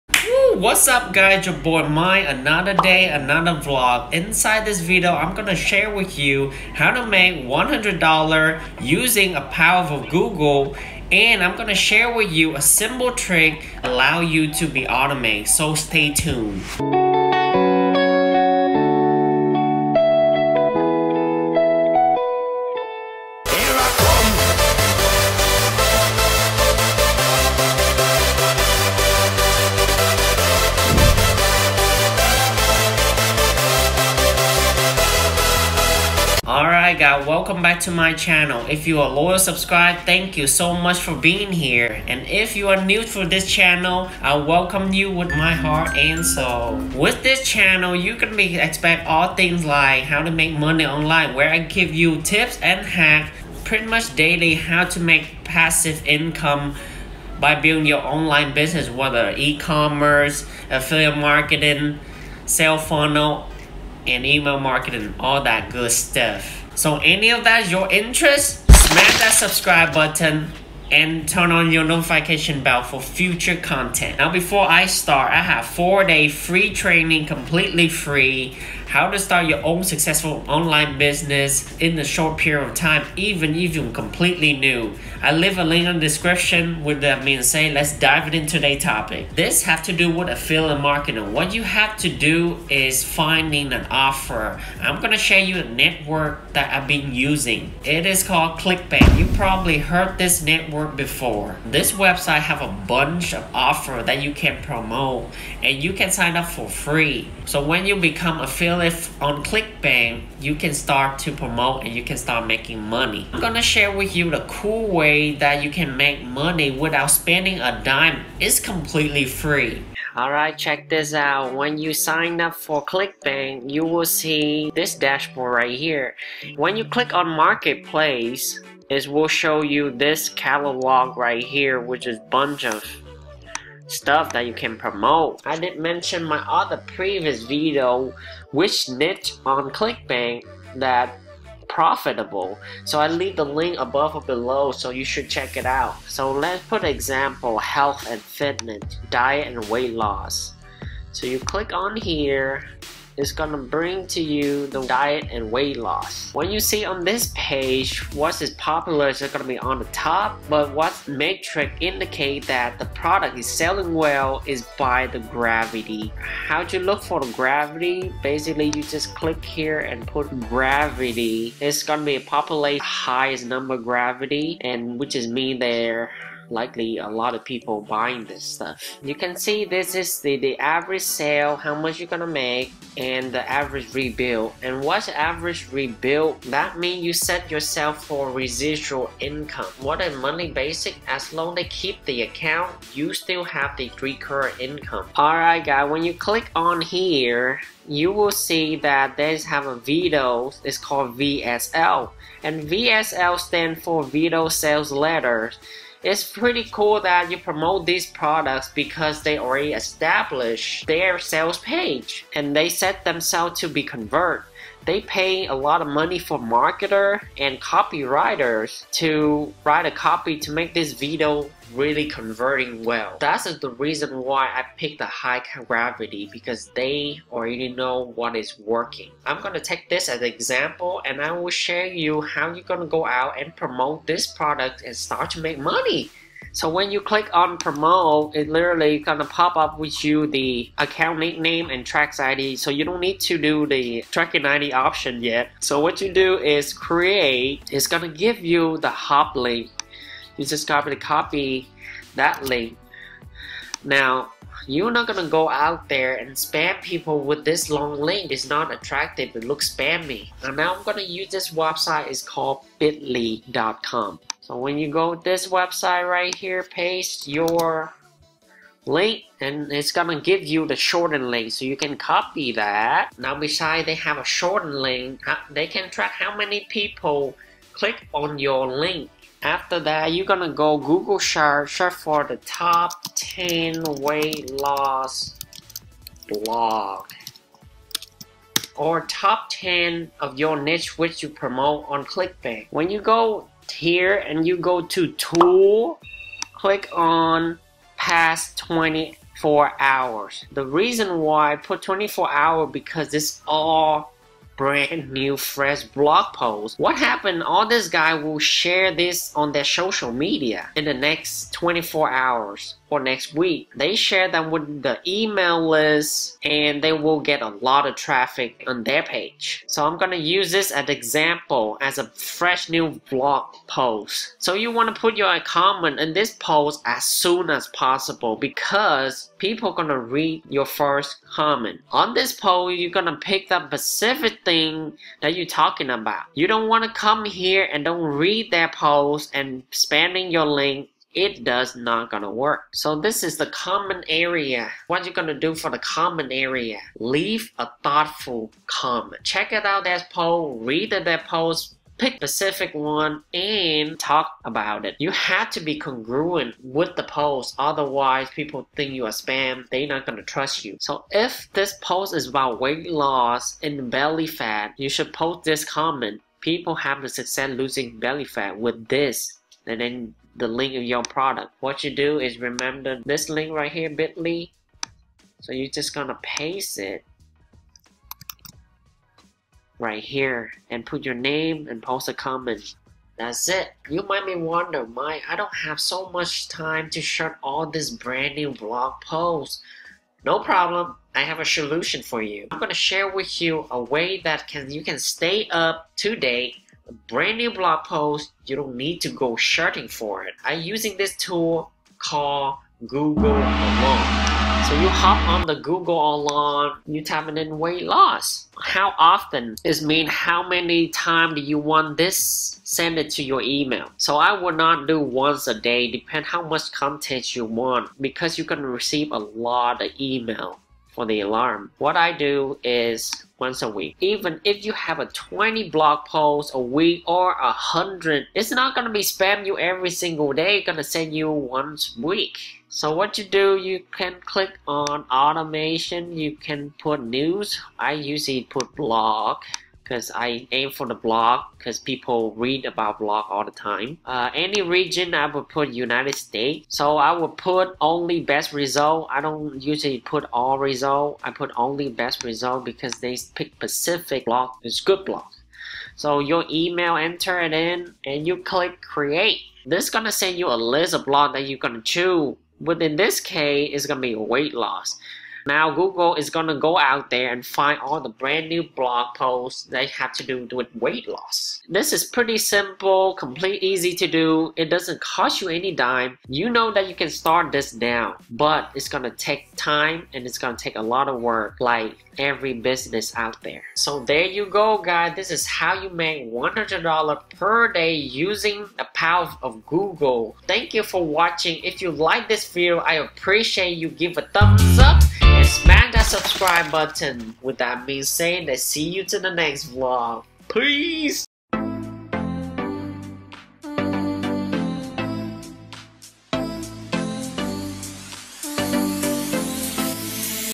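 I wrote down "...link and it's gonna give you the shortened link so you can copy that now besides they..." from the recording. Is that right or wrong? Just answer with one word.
right.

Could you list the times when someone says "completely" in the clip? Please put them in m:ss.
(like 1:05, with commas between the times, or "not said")
1:17, 1:23, 1:58, 7:53.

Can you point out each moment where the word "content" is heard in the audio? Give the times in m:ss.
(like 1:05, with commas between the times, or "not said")
1:13, 6:56.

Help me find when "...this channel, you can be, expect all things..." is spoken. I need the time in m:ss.
0:47.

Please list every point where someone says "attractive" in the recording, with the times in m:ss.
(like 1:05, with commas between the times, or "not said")
4:18.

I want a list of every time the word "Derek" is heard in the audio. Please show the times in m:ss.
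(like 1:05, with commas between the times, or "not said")
not said.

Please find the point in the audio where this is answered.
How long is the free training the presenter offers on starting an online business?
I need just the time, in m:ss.
1:15.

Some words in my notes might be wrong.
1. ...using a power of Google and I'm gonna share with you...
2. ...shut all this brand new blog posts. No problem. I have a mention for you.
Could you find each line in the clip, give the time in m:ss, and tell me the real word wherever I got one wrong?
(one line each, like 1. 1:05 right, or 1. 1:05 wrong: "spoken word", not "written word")
1. 0:08 right
2. 6:27 wrong: "solution", not "mention".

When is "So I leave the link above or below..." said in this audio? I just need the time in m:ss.
2:22.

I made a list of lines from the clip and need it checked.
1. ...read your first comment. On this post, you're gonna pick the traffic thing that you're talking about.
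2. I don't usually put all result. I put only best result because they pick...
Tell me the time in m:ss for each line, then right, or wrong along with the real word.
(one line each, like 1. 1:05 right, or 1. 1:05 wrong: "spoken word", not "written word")
1. 5:29 wrong: "specific", not "traffic"
2. 7:29 right.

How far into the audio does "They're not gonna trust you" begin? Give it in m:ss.
5:59.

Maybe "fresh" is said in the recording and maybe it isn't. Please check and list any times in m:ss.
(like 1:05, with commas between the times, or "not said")
5:05, 5:22.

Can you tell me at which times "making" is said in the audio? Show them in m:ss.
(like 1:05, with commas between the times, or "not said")
1:52.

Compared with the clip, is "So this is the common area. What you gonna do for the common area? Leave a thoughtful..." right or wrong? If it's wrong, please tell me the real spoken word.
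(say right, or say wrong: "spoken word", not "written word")
right.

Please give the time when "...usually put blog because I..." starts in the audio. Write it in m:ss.
7:17.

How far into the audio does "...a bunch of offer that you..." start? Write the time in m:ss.
1:42.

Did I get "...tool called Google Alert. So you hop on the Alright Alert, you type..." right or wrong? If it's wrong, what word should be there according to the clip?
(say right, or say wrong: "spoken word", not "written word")
wrong: "Google", not "Alright".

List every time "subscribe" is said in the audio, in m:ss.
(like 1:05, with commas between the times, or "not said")
0:39, 1:09, 8:16.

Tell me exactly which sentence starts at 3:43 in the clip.
That's the reason why I picked the high gravity because they already know what is working.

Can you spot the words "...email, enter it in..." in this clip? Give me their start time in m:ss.
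7:36.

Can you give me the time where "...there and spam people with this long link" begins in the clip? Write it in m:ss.
4:15.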